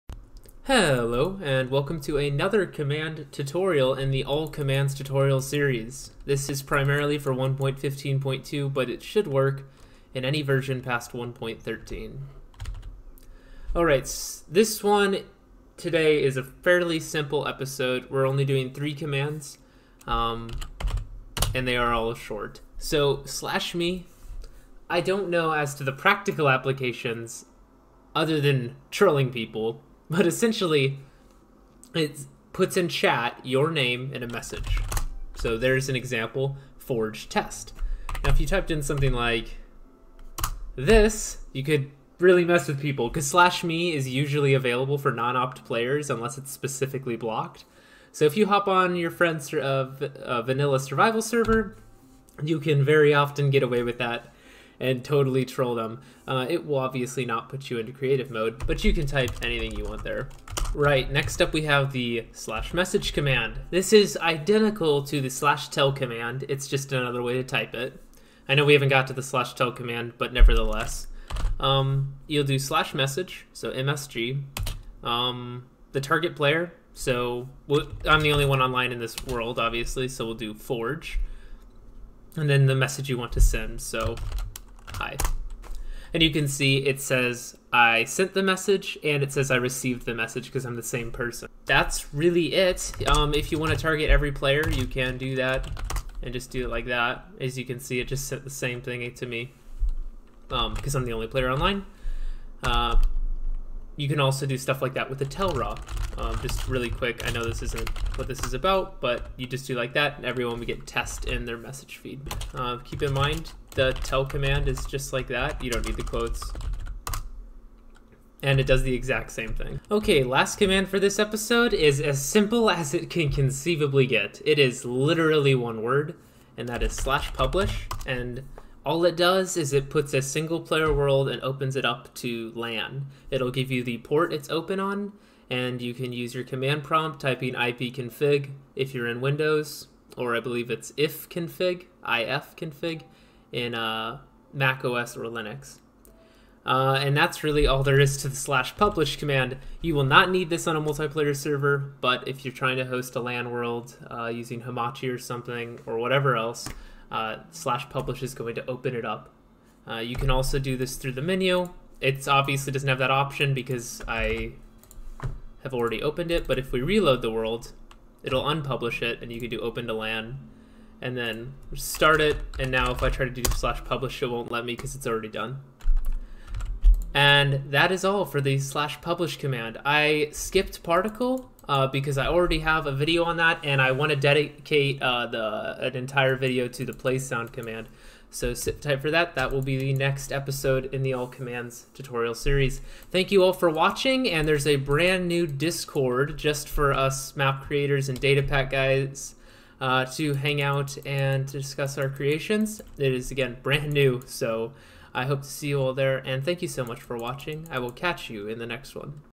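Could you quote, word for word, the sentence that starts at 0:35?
So there's an example forge test.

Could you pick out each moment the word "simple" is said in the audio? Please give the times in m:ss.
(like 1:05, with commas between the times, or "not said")
0:16, 2:02.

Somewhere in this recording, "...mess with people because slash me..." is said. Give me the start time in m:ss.
0:42.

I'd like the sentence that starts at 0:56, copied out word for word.
Uh, it will obviously not put you into creative mode, but you can type anything you want there.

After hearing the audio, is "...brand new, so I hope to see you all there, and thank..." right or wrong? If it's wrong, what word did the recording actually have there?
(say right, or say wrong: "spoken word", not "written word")
right.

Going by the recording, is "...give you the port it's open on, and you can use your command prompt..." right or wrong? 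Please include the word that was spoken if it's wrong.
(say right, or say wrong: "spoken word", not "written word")
right.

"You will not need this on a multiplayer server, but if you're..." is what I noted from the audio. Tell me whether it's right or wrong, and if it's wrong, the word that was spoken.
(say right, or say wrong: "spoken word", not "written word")
right.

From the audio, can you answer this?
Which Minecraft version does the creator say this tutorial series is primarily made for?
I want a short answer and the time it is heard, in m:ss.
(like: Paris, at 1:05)
1.15.2, at 0:07.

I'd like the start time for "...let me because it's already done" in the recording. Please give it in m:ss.
2:54.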